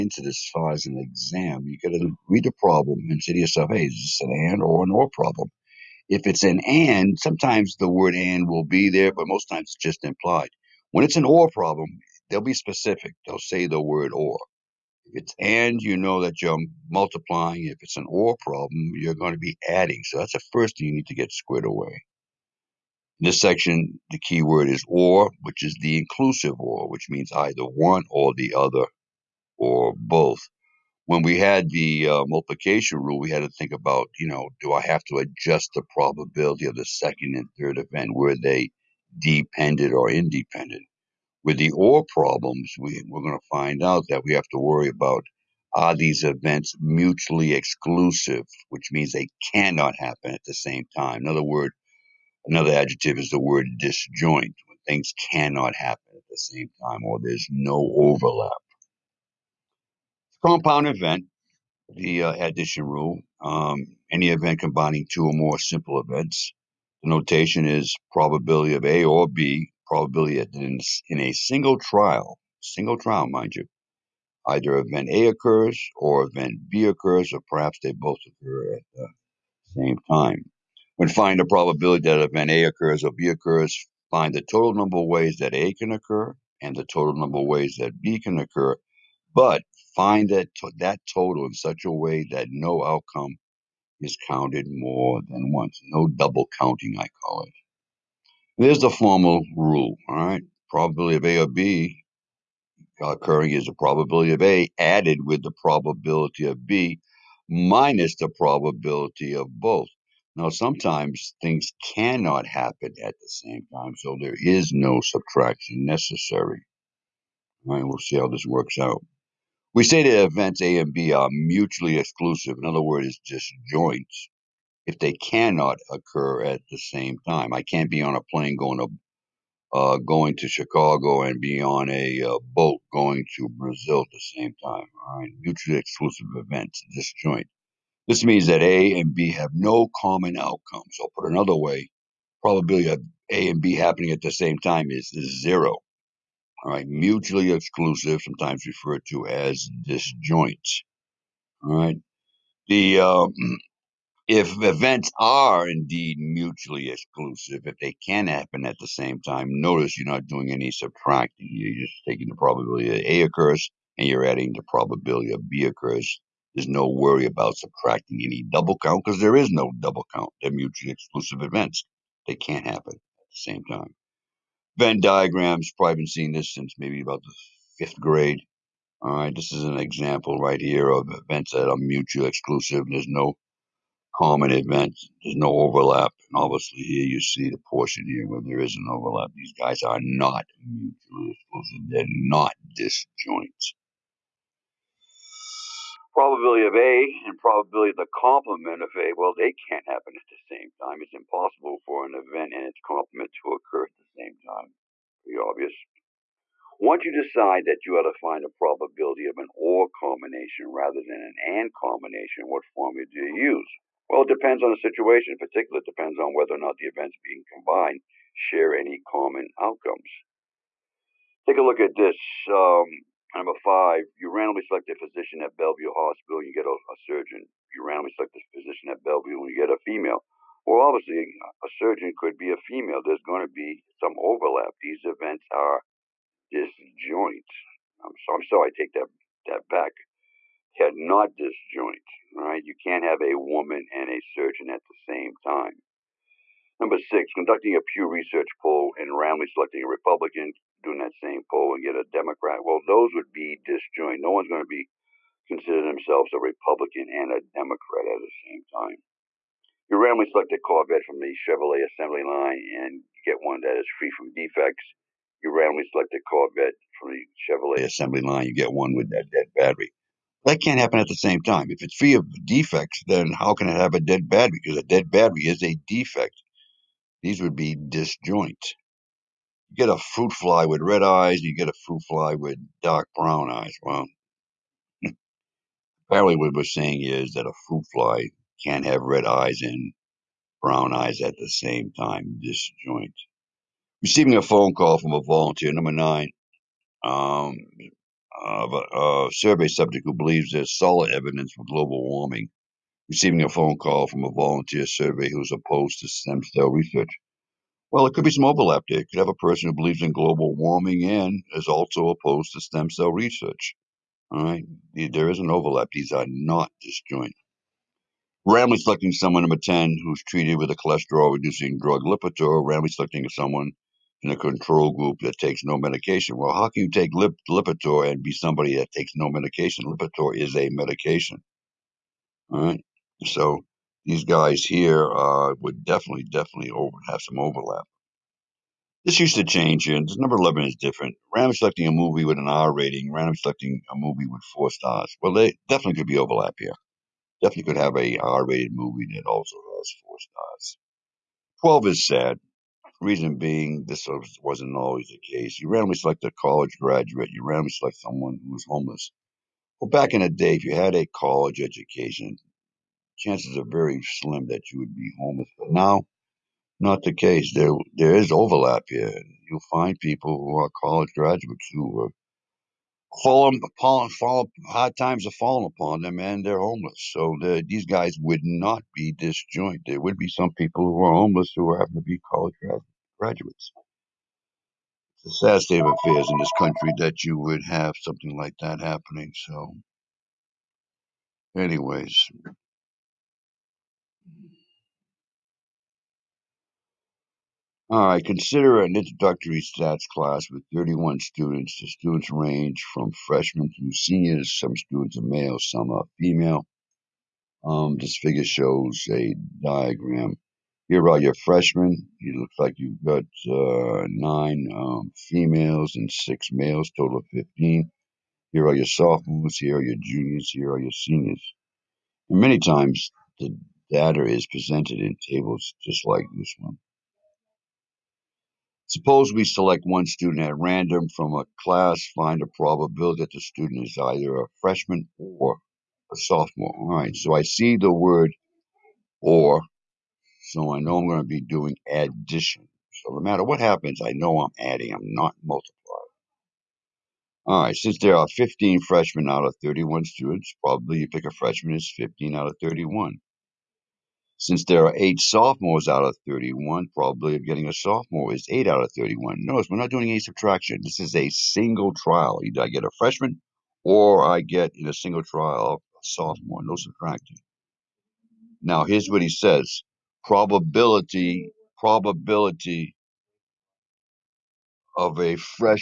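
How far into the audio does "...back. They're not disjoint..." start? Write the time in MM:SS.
03:59.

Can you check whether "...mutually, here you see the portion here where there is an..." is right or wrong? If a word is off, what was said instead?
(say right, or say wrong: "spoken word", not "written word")
wrong: "obviously", not "mutually".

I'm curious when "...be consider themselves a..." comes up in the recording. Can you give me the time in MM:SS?
04:14.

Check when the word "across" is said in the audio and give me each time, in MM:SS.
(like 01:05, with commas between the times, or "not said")
not said.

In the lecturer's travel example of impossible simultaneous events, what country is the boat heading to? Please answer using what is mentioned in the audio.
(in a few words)
Brazil.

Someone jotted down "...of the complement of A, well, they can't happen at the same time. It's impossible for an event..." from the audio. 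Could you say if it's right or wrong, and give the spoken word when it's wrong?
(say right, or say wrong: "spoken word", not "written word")
right.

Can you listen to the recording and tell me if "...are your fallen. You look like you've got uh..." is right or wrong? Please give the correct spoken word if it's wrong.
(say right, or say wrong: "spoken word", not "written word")
wrong: "freshmen", not "fallen".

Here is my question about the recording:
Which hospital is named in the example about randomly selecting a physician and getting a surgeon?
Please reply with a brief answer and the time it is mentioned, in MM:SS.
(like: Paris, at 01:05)
Bellevue Hospital, at 03:45.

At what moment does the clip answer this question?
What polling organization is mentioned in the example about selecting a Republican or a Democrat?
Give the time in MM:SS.
04:07.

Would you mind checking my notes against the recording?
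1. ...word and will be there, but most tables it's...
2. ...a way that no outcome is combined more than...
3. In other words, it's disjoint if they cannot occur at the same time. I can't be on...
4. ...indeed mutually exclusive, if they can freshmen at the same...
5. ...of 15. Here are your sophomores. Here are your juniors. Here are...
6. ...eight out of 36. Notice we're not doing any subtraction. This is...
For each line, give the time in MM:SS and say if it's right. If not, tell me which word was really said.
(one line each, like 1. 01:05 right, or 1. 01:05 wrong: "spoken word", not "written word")
1. 00:07 wrong: "times", not "tables"
2. 01:31 wrong: "counted", not "combined"
3. 02:02 right
4. 02:35 wrong: "happen", not "freshmen"
5. 06:57 right
6. 07:38 wrong: "31", not "36".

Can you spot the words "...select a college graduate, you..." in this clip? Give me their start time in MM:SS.
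05:55.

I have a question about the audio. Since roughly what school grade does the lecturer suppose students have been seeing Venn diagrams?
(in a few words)
fifth grade.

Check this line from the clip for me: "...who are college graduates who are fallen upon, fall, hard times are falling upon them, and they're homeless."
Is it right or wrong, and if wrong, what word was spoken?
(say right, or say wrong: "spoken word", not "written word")
right.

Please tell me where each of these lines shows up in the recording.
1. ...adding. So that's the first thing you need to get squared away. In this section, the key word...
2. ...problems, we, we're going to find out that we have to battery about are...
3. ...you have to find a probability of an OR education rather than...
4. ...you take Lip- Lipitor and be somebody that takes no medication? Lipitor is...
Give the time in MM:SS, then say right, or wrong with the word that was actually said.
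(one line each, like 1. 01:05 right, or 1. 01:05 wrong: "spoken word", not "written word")
1. 00:19 right
2. 00:42 wrong: "worry", not "battery"
3. 03:27 wrong: "combination", not "education"
4. 05:26 right.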